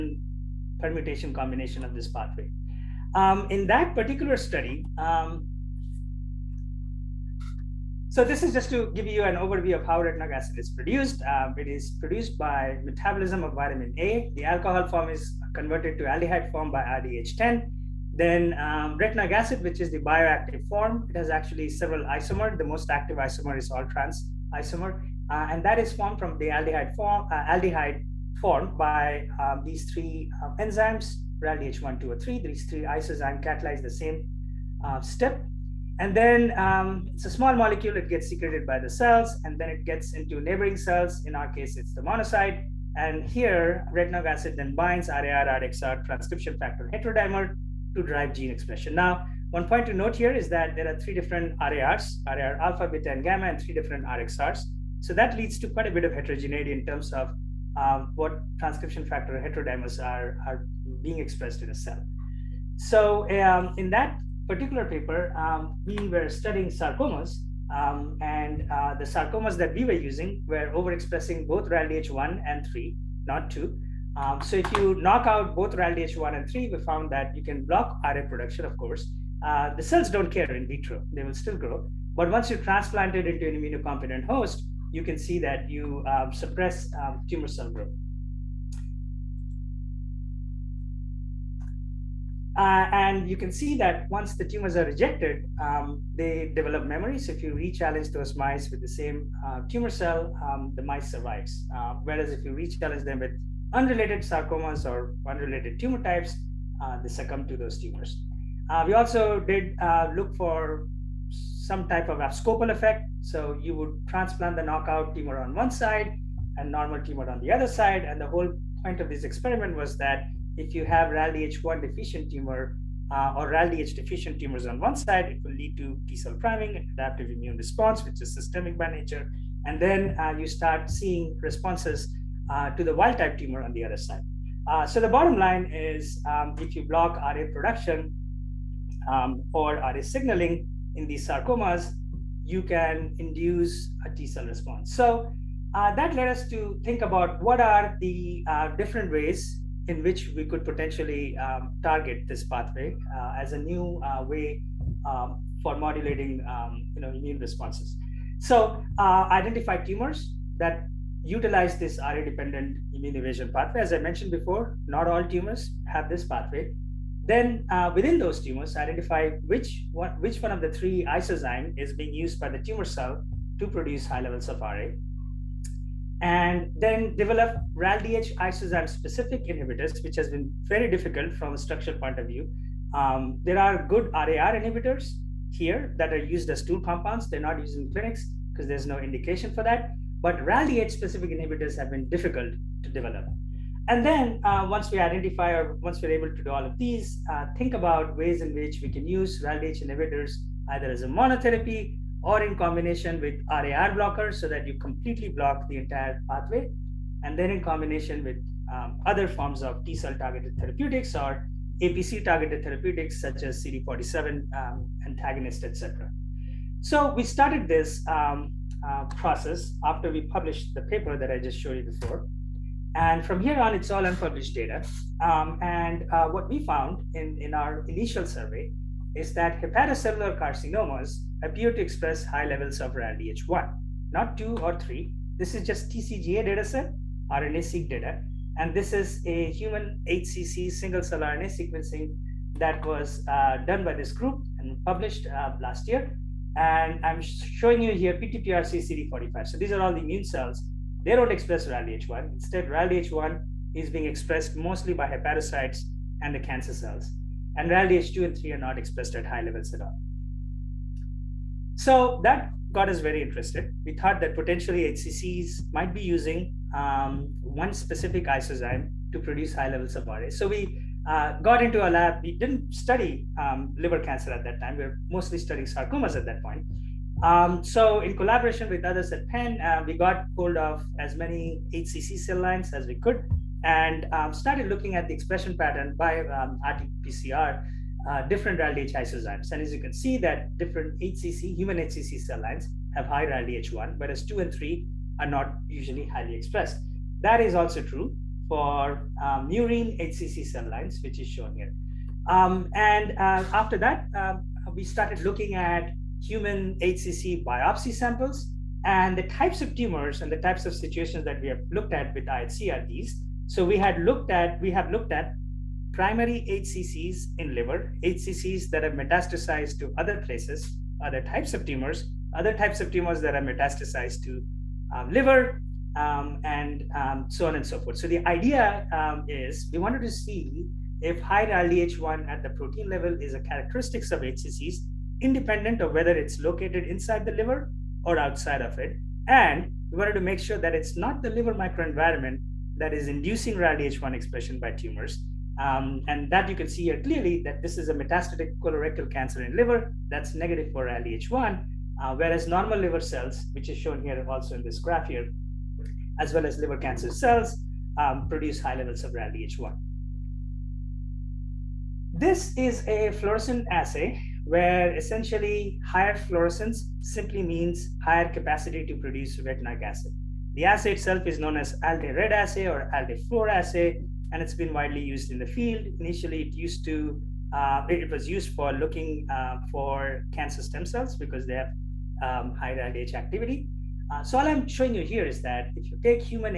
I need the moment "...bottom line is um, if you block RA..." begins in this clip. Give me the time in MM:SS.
02:15.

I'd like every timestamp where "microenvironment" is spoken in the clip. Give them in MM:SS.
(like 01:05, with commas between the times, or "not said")
05:41.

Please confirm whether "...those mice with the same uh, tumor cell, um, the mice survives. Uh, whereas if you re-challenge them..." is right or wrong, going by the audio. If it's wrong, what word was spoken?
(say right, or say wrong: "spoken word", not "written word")
right.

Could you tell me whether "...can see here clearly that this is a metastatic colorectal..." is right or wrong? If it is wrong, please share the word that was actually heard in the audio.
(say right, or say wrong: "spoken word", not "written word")
right.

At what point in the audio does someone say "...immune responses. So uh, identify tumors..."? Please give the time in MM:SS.
02:37.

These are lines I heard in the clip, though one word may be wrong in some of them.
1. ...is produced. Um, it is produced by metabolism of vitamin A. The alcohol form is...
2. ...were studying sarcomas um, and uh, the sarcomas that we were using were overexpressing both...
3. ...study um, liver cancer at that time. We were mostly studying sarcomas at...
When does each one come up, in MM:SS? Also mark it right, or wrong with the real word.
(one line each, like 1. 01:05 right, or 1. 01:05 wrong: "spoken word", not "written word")
1. 00:10 right
2. 01:06 right
3. 04:32 right.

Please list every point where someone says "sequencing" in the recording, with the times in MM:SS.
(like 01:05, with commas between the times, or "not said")
04:01.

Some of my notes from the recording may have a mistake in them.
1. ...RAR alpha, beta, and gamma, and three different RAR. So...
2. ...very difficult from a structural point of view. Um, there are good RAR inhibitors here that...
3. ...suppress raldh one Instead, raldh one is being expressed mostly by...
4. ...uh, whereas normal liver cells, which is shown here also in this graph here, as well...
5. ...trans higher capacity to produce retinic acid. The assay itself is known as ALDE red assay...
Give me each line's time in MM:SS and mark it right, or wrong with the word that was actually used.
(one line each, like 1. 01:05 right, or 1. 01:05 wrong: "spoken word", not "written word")
1. 00:52 wrong: "RXRs", not "RAR"
2. 03:00 right
3. 04:11 wrong: "express", not "suppress"
4. 05:52 right
5. 06:07 wrong: "means", not "trans".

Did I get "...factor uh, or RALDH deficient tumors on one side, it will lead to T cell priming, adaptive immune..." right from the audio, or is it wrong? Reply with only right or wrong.
wrong.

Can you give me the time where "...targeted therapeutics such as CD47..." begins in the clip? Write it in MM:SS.
03:32.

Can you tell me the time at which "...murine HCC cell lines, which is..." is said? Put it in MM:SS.
04:59.